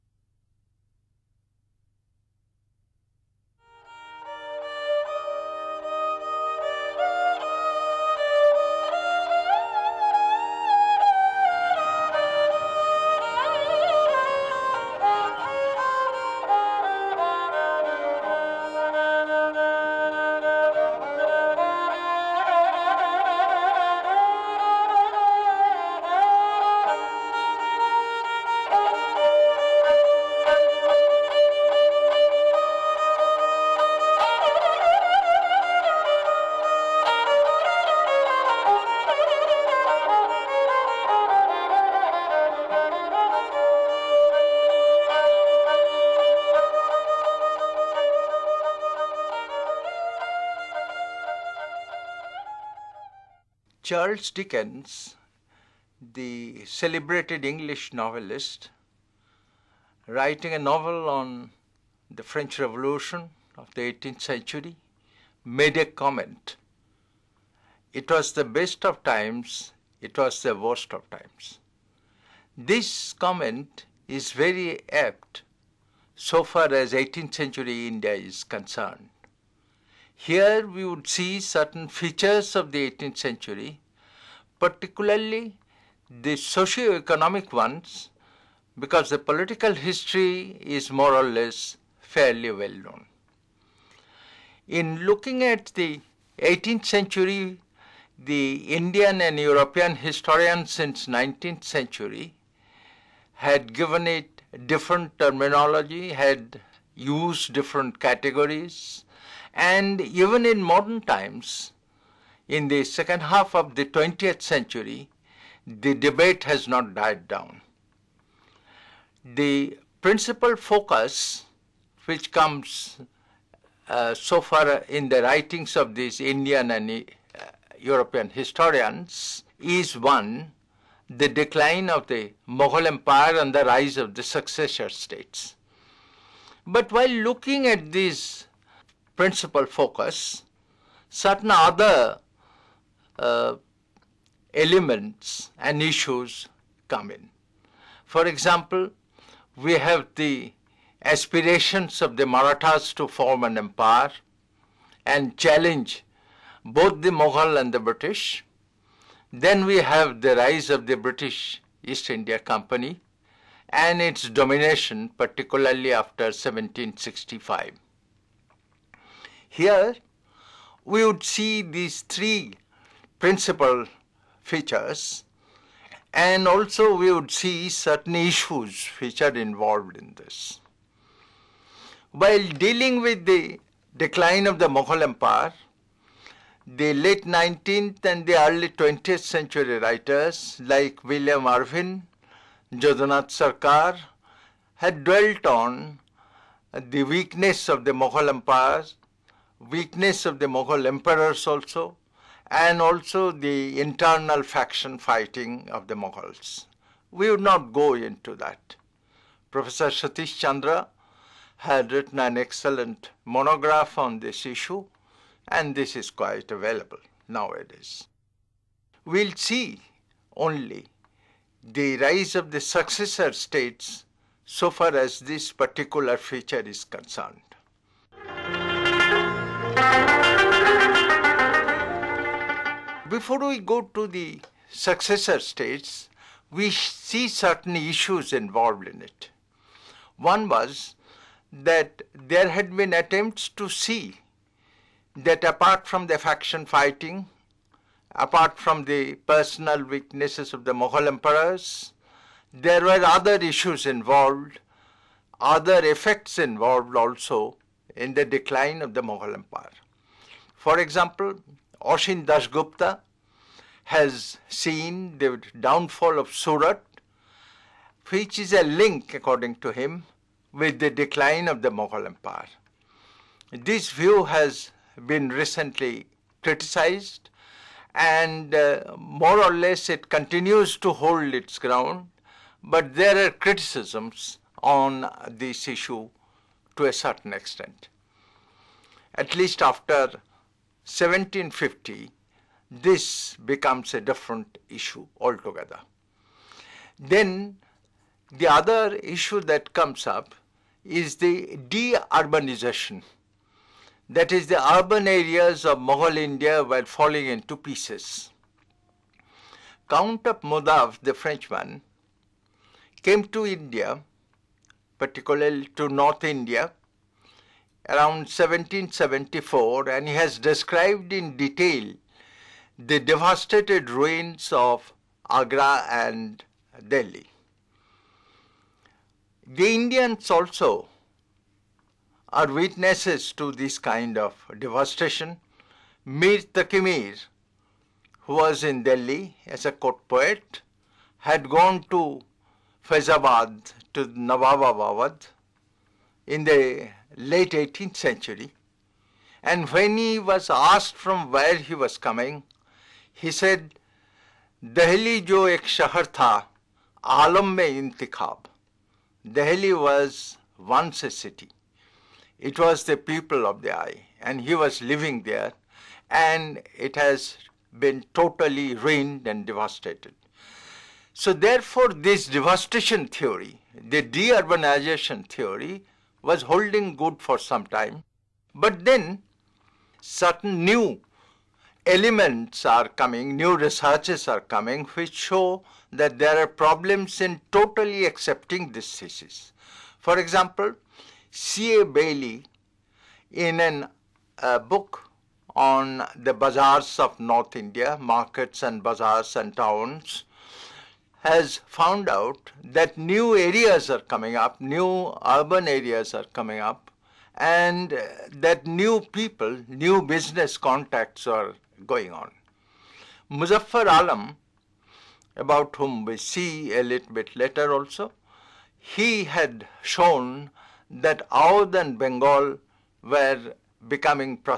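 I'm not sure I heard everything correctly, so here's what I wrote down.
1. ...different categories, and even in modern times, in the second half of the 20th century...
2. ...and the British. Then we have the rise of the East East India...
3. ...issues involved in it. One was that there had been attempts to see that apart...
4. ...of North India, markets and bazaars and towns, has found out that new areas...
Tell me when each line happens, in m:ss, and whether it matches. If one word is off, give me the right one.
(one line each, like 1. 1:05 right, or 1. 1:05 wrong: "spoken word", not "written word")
1. 1:47 right
2. 2:37 wrong: "British", not "East"
3. 3:57 right
4. 6:36 right.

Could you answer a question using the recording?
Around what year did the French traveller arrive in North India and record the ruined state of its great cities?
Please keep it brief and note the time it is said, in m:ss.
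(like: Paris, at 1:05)
1774, at 5:18.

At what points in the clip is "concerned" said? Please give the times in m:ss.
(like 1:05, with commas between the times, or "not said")
1:18, 3:46.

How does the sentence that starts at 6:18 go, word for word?
But then certain new elements are coming, new researches are coming, which show that there are problems in totally accepting this thesis.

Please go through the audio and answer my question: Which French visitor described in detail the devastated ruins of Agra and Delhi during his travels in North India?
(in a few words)
Count of Modave.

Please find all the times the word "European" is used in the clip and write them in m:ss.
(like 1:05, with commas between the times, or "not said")
1:39, 2:07.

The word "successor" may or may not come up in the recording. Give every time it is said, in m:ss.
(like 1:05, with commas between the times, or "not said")
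2:14, 3:42, 3:54.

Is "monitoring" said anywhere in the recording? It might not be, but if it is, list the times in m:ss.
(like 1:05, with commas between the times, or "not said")
not said.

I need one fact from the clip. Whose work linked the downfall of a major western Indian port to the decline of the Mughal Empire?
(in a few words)
Oshin Gupta.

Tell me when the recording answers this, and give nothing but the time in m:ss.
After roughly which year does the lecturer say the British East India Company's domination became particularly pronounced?
2:46.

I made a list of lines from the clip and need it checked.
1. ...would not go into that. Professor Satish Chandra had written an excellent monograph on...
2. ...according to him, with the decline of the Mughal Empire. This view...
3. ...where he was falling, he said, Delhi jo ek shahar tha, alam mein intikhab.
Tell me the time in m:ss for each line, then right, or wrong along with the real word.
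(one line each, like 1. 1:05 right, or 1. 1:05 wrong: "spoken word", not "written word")
1. 3:27 right
2. 4:29 right
3. 5:51 wrong: "coming", not "falling".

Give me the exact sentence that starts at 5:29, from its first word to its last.
The Indians also are witnesses to this kind of devastation.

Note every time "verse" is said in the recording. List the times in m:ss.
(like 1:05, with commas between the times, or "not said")
not said.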